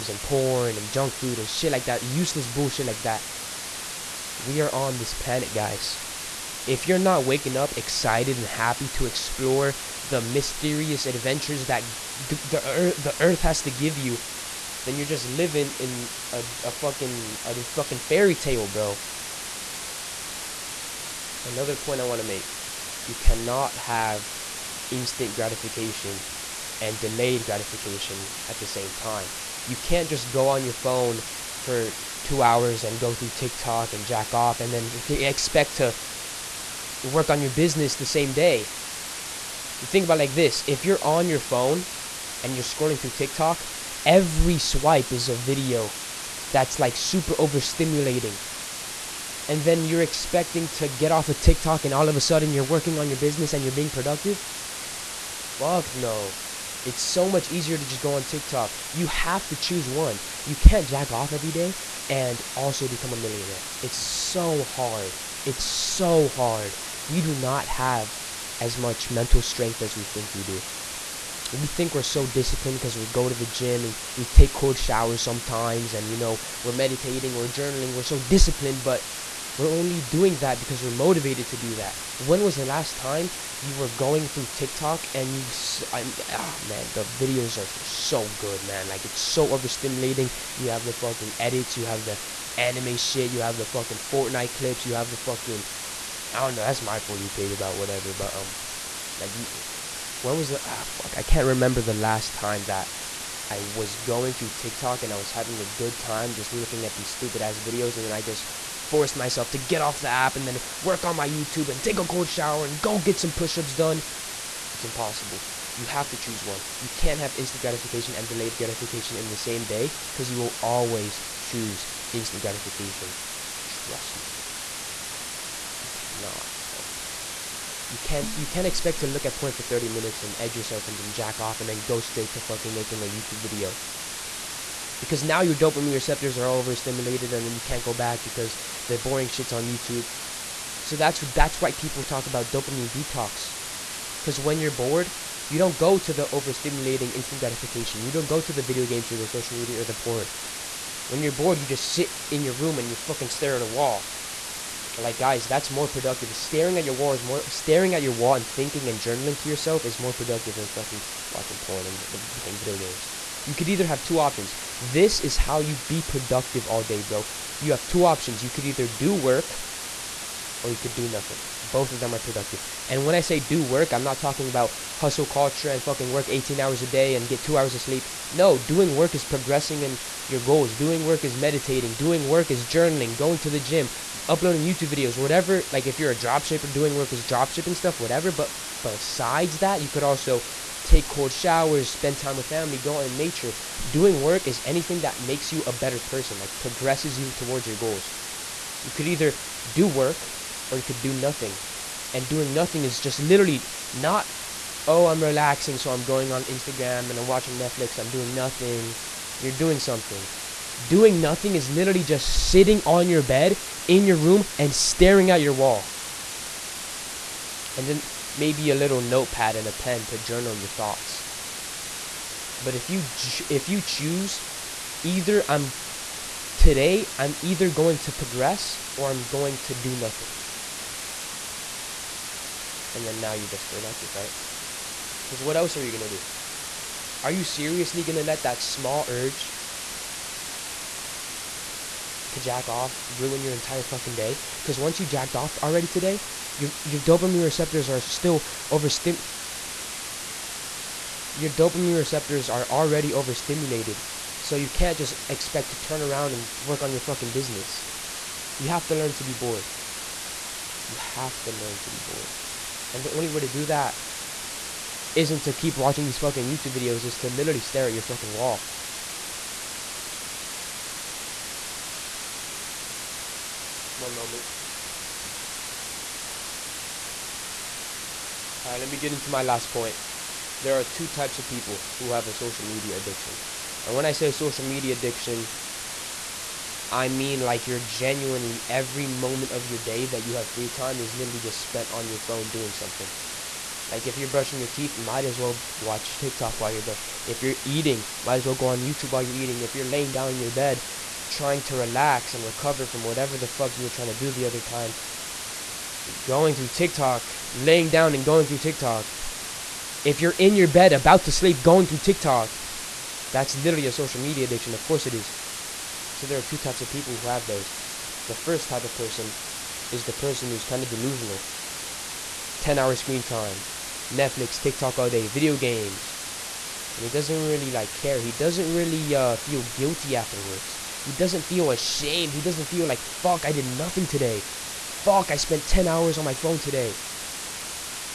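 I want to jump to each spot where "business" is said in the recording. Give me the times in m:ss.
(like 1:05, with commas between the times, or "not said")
0:37, 0:53, 4:17.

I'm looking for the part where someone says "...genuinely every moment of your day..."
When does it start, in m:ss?
4:47.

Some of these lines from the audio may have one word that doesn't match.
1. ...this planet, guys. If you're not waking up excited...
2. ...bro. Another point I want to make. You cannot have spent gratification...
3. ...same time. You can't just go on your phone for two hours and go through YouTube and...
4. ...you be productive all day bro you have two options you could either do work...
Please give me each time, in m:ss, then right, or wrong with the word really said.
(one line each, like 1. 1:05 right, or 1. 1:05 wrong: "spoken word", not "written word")
1. 0:04 right
2. 0:18 wrong: "instant", not "spent"
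3. 0:28 wrong: "TikTok", not "YouTube"
4. 2:45 right.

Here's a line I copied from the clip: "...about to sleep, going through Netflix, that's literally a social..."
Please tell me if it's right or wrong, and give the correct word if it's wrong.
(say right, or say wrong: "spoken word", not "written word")
wrong: "TikTok", not "Netflix".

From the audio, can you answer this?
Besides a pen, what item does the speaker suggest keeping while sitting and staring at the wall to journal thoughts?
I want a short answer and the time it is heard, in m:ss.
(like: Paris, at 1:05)
notepad, at 3:39.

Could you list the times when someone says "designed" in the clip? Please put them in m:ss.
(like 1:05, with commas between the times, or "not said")
not said.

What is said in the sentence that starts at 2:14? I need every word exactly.
Because now your dopamine receptors are overstimulated and then you can't go back because the boring shit's on YouTube.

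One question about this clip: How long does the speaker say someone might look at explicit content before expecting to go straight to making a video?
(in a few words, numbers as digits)
30 minutes.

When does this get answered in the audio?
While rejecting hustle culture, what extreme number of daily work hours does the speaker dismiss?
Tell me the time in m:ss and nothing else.
2:56.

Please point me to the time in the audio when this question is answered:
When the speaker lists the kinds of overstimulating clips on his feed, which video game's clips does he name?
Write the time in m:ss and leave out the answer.
1:34.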